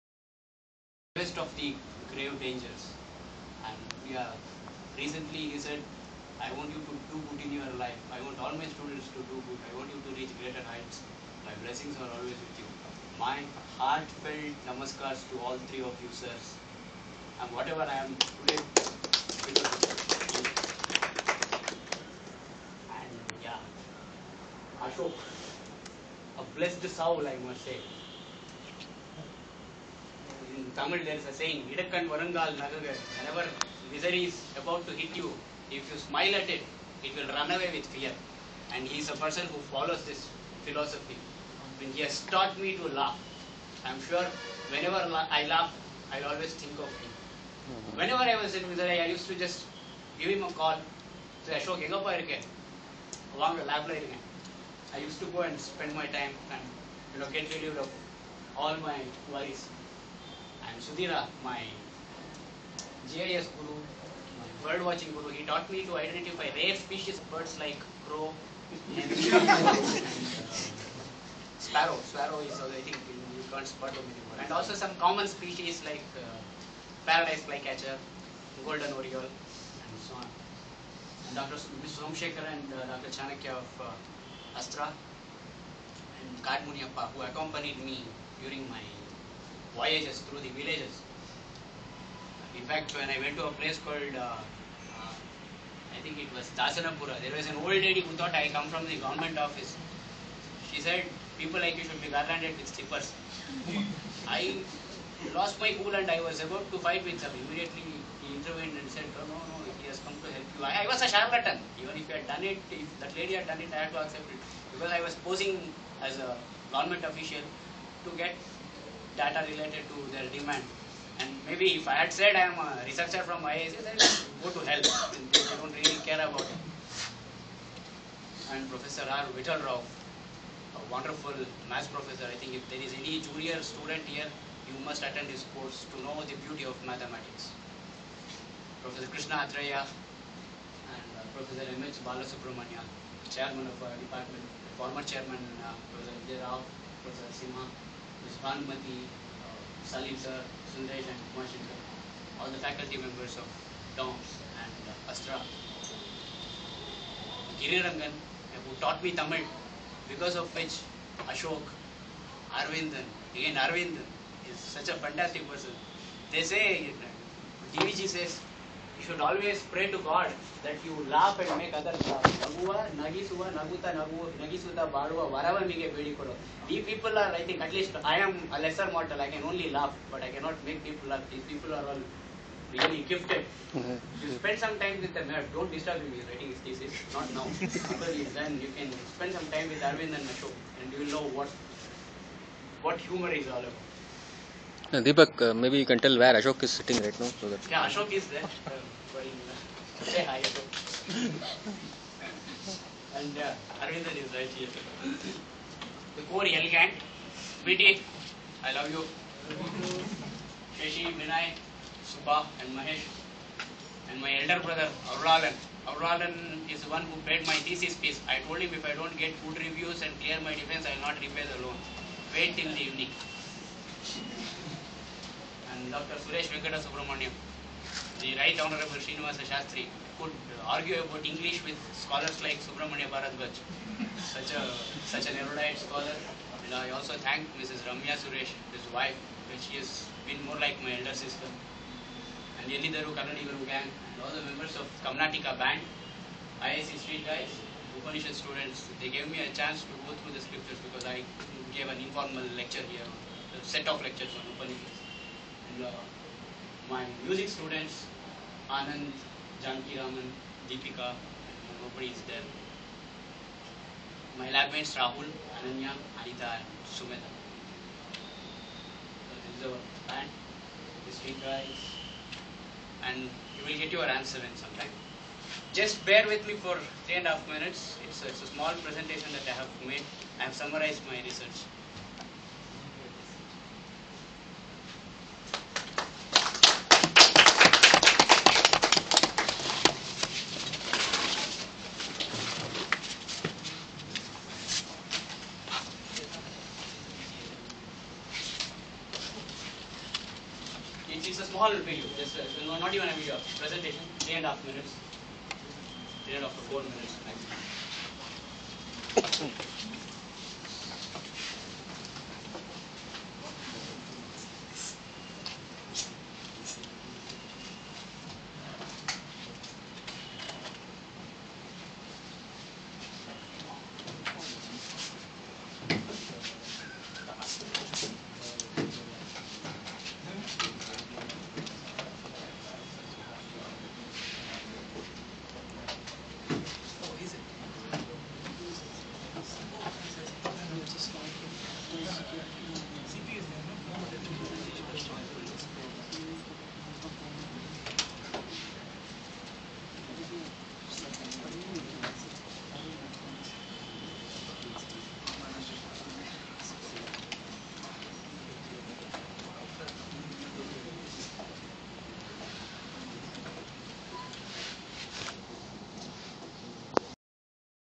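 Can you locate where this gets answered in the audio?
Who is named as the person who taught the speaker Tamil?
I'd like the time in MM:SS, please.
02:37.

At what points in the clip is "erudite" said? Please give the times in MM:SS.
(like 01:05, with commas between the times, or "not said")
03:55.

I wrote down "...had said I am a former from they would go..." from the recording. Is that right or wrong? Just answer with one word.
wrong.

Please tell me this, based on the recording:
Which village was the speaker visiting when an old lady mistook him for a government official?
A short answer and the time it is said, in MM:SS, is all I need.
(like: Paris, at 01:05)
Dasanapura, at 01:36.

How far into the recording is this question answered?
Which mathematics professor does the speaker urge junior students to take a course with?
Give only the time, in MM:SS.
02:09.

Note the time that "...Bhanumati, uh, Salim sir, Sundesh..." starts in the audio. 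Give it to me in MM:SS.
02:28.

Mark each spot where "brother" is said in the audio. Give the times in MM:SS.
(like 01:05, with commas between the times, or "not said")
03:34.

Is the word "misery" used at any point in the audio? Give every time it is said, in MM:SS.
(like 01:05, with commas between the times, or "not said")
00:33, 00:48.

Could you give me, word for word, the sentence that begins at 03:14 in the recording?
No, Deepak, uh, maybe you can tell where Ashok is sitting right now.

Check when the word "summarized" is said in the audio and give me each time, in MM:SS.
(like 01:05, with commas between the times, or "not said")
04:40.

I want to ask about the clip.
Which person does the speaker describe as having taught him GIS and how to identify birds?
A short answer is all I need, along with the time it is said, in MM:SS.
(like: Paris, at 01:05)
Sudhira, at 01:00.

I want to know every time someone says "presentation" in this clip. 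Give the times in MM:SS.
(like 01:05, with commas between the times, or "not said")
04:38, 05:03.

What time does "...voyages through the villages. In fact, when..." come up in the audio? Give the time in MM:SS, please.
01:29.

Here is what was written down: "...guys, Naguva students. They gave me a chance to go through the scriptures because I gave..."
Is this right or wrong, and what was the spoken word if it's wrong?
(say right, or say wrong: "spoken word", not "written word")
wrong: "Upanishad", not "Naguva".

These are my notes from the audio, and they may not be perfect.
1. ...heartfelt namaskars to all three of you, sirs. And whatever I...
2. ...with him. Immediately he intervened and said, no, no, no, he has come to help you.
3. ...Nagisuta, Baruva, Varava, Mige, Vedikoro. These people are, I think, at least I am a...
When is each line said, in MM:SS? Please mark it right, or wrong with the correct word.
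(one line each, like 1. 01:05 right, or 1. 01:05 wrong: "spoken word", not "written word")
1. 00:13 right
2. 01:47 right
3. 02:54 right.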